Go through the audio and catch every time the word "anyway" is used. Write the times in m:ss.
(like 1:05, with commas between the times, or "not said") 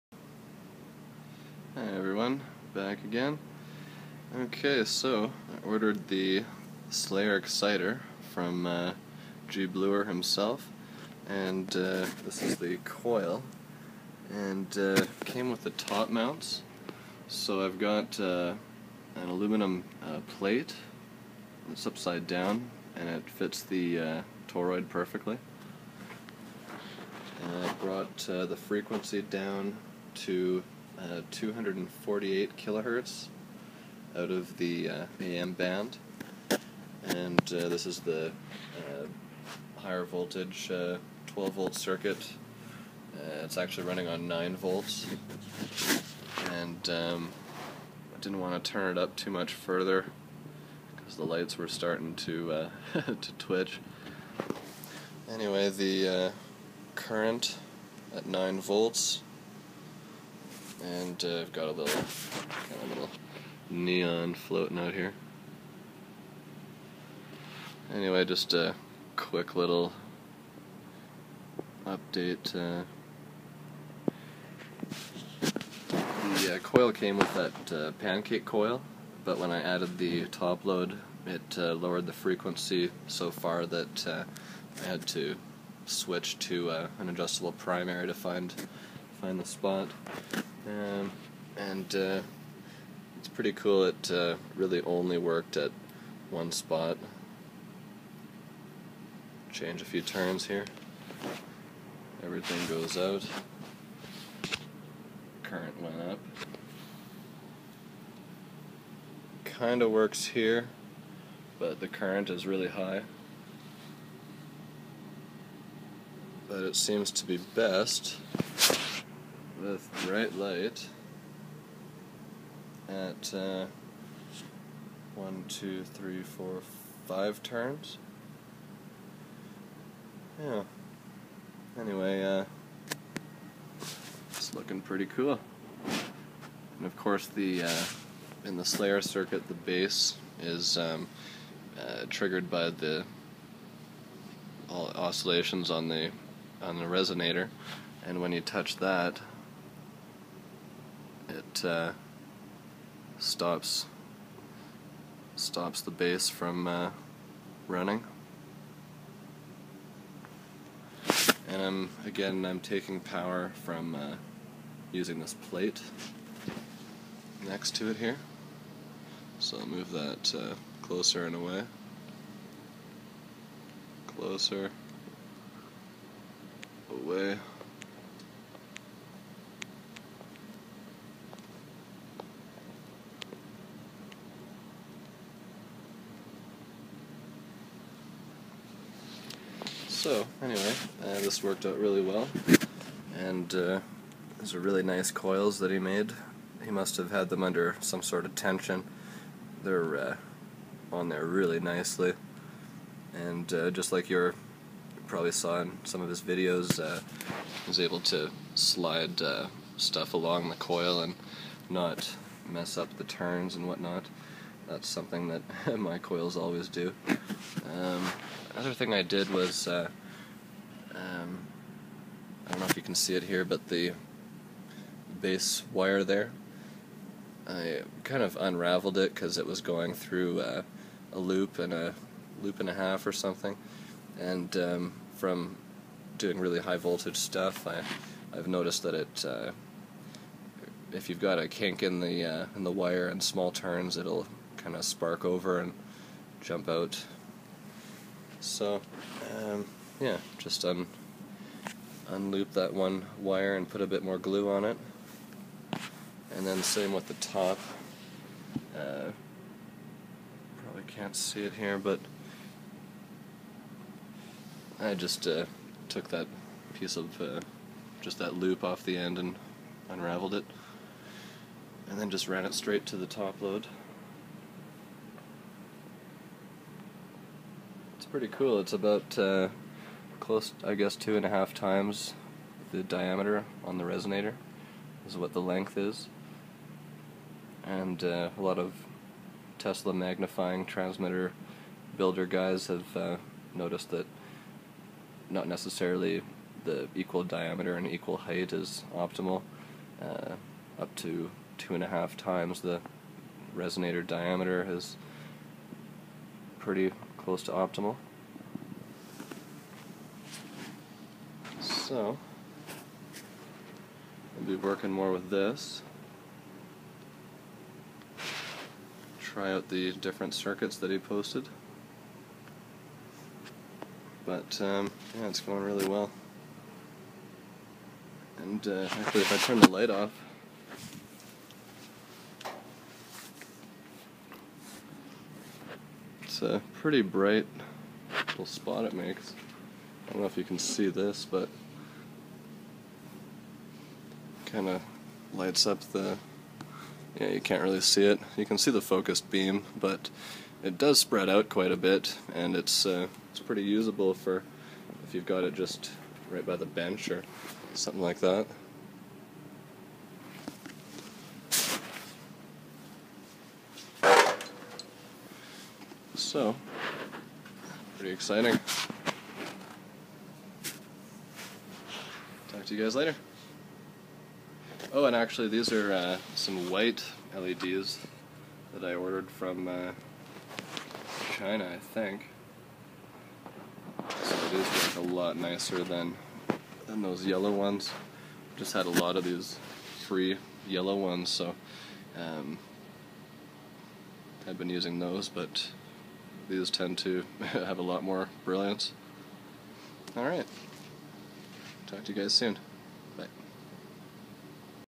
0:55, 1:07, 2:11, 3:10.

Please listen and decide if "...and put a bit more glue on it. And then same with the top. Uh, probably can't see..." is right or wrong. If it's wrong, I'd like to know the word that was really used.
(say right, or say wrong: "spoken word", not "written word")
right.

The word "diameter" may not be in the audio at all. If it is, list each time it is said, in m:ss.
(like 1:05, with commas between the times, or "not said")
4:42, 4:57, 5:04.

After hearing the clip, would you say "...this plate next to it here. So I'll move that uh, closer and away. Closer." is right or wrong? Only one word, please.
right.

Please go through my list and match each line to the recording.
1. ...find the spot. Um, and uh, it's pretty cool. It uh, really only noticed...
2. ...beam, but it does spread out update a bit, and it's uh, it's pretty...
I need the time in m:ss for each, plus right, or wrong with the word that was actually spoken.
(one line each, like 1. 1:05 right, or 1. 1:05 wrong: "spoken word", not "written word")
1. 1:29 wrong: "worked", not "noticed"
2. 5:49 wrong: "quite", not "update".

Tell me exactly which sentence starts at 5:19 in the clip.
Try out the different circuits that he posted.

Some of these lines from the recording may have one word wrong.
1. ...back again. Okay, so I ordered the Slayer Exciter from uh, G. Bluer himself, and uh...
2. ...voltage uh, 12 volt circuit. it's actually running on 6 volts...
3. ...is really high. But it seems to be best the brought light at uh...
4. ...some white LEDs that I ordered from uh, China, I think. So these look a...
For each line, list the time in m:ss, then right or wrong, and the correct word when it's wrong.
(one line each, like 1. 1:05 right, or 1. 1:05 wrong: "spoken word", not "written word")
1. 0:02 right
2. 0:40 wrong: "9", not "6"
3. 1:52 wrong: "bright", not "brought"
4. 6:16 right.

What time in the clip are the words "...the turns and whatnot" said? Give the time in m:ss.
3:32.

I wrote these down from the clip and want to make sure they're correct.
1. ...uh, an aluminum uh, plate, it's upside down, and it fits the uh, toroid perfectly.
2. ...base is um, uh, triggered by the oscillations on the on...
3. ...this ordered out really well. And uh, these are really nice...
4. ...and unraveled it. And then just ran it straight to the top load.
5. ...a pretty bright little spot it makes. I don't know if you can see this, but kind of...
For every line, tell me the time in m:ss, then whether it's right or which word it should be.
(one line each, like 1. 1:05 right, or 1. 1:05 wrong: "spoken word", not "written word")
1. 0:18 right
2. 2:19 right
3. 3:11 wrong: "worked", not "ordered"
4. 4:29 right
5. 5:36 right.